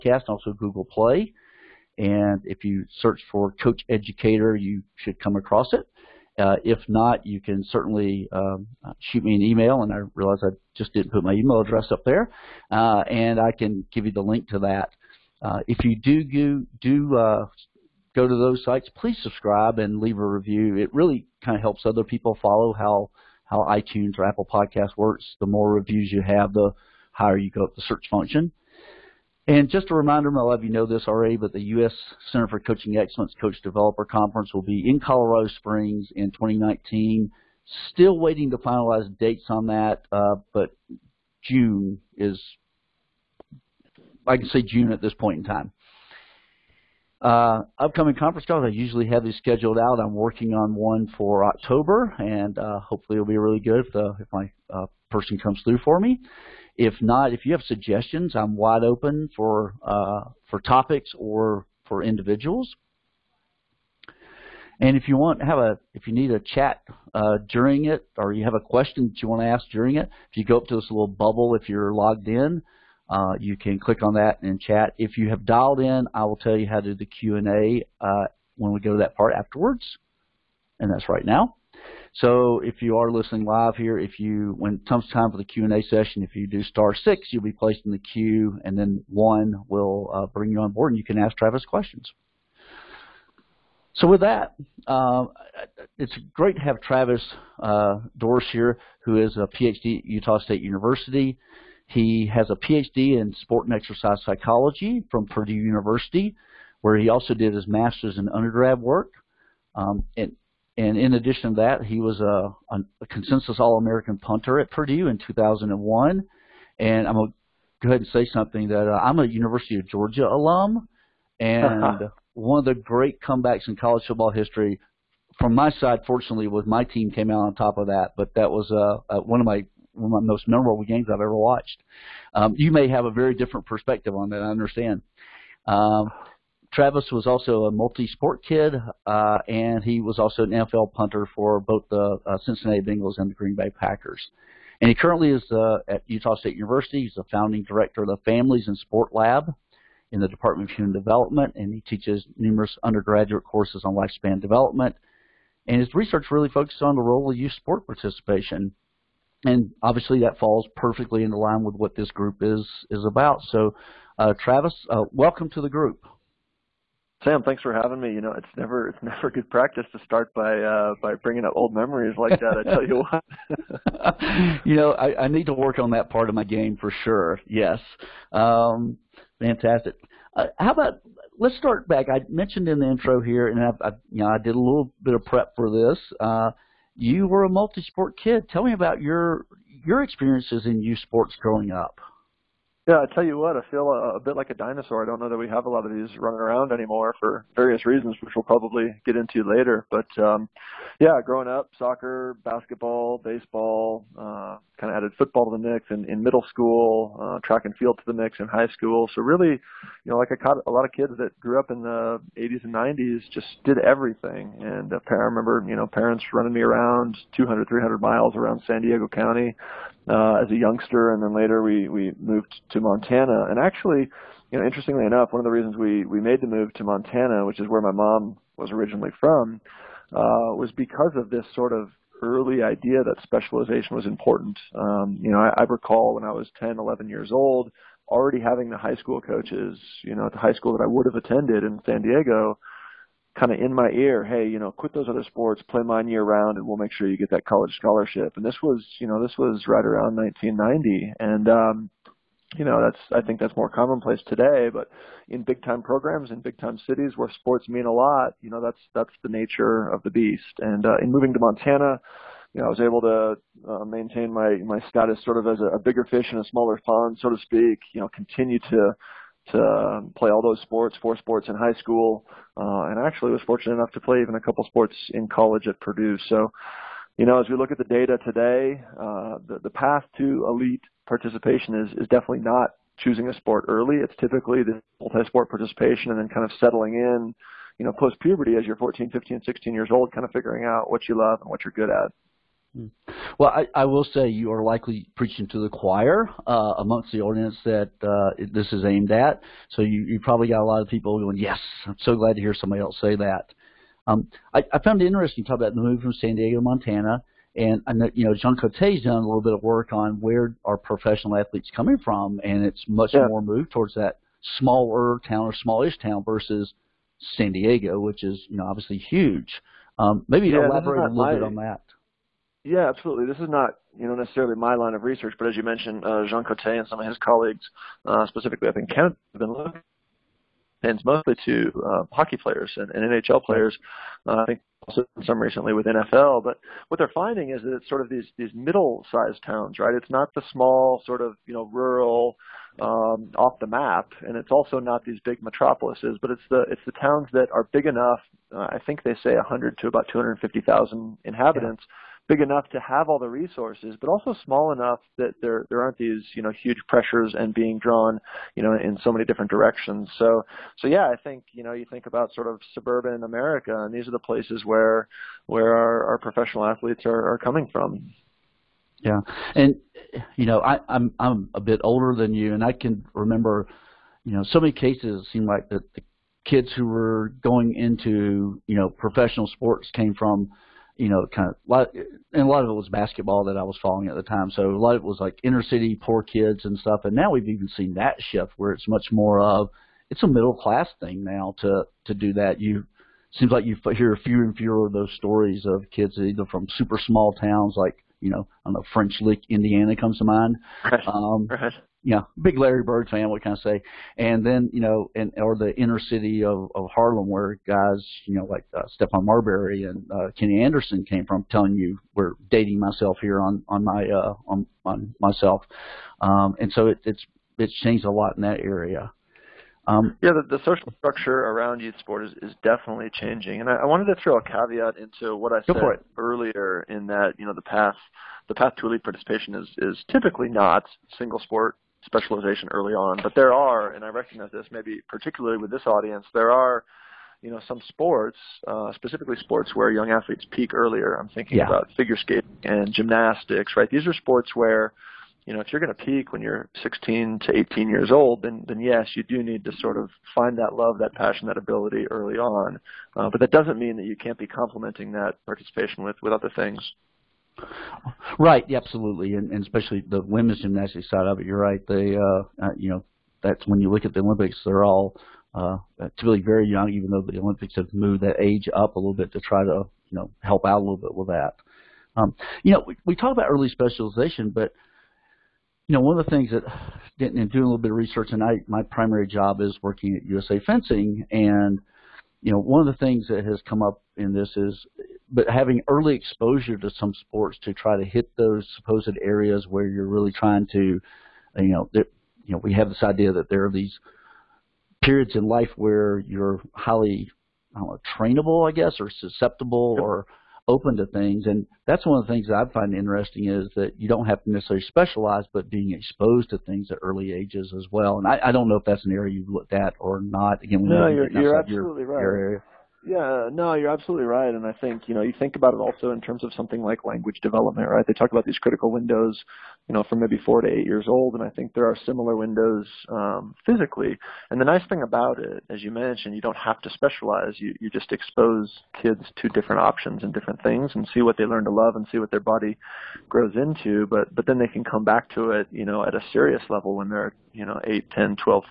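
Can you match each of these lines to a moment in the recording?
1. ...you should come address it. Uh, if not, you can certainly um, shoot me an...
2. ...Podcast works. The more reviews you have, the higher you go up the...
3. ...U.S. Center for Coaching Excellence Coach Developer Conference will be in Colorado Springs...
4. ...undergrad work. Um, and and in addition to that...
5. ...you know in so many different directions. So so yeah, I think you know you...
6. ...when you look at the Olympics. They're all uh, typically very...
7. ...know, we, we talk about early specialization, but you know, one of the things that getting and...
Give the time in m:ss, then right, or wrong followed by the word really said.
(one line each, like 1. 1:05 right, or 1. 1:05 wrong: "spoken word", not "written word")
1. 0:04 wrong: "across", not "address"
2. 0:24 right
3. 0:31 right
4. 1:48 right
5. 5:58 right
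6. 7:43 right
7. 7:52 right.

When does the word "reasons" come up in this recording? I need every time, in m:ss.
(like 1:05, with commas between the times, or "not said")
3:17, 3:45.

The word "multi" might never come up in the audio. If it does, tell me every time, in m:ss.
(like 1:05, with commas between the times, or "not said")
2:17, 3:07, 4:45.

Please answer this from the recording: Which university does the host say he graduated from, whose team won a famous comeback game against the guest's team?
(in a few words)
University of Georgia.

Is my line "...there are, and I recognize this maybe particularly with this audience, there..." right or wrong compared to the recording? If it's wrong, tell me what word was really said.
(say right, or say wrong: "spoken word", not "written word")
right.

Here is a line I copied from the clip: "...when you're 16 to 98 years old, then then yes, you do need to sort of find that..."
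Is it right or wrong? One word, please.
wrong.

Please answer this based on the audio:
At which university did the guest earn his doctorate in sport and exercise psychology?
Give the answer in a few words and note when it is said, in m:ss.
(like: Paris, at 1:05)
Purdue University, at 1:45.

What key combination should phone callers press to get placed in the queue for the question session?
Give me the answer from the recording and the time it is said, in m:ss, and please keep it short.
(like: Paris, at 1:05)
star six, at 1:26.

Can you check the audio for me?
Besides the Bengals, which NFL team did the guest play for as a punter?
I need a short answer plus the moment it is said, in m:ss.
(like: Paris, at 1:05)
Green Bay Packers, at 2:23.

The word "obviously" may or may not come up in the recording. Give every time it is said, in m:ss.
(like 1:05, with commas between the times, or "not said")
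2:39, 5:18.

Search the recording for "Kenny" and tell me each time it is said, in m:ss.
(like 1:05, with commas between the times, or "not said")
6:50.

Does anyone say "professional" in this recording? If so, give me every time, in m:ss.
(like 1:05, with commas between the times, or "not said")
5:10, 6:06, 6:18.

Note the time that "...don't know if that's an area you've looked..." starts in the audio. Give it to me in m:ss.
8:28.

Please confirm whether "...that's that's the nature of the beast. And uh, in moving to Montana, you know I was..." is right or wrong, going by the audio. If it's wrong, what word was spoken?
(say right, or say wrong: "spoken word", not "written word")
right.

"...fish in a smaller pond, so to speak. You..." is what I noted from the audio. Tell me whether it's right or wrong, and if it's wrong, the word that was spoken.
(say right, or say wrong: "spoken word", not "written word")
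right.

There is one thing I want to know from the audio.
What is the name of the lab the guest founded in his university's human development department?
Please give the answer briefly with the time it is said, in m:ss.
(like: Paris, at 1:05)
Families and Sport Lab, at 2:28.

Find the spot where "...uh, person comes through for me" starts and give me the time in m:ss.
0:54.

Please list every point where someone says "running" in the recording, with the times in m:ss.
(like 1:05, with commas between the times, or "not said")
3:16, 3:36.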